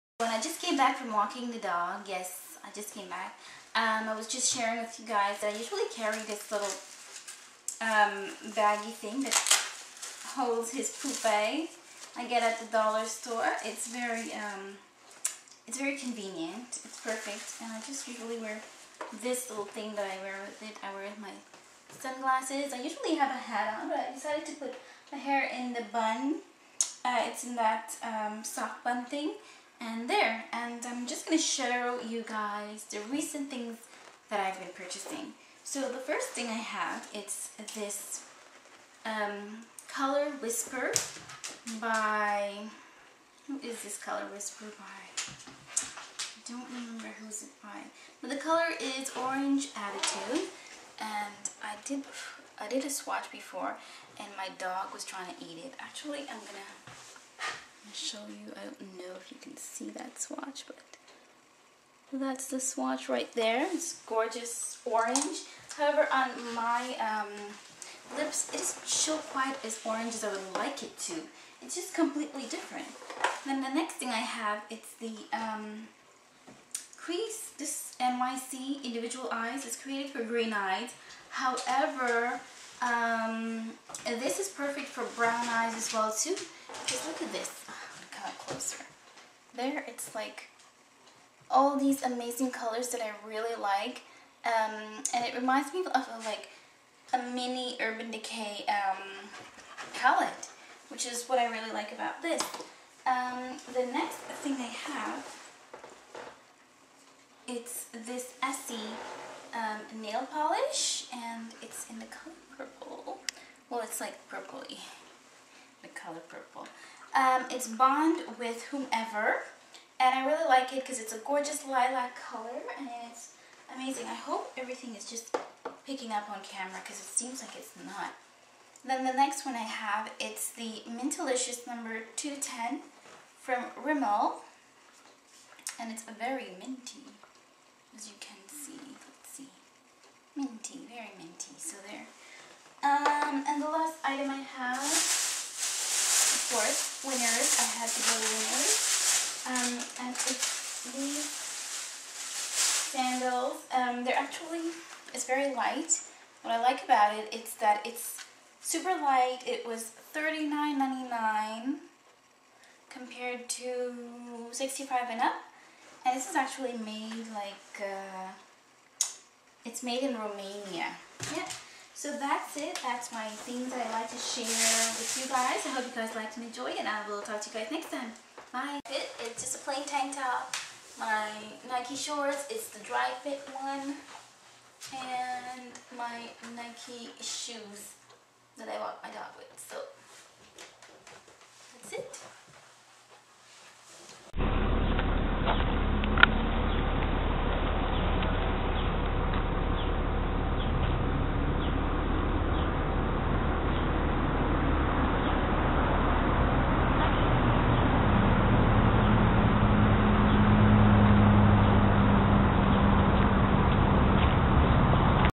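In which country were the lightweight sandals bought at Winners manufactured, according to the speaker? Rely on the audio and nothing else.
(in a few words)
Romania.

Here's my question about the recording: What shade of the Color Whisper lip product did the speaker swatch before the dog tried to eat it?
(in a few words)
Orange Attitude.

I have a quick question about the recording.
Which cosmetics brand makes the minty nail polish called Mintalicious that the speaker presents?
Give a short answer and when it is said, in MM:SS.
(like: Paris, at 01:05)
Rimmel, at 02:13.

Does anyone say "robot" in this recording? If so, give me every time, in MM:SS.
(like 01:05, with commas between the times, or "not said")
not said.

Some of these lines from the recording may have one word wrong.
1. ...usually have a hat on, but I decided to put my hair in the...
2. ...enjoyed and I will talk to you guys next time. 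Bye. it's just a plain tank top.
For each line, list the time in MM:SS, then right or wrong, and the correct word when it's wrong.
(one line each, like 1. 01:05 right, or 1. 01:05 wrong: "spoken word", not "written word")
1. 00:22 right
2. 02:56 right.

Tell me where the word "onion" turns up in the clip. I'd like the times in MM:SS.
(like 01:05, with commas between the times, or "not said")
not said.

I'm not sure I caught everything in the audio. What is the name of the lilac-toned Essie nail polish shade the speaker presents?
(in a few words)
Bond with Whomever.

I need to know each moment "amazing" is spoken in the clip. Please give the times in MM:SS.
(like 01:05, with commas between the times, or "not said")
01:32, 02:03.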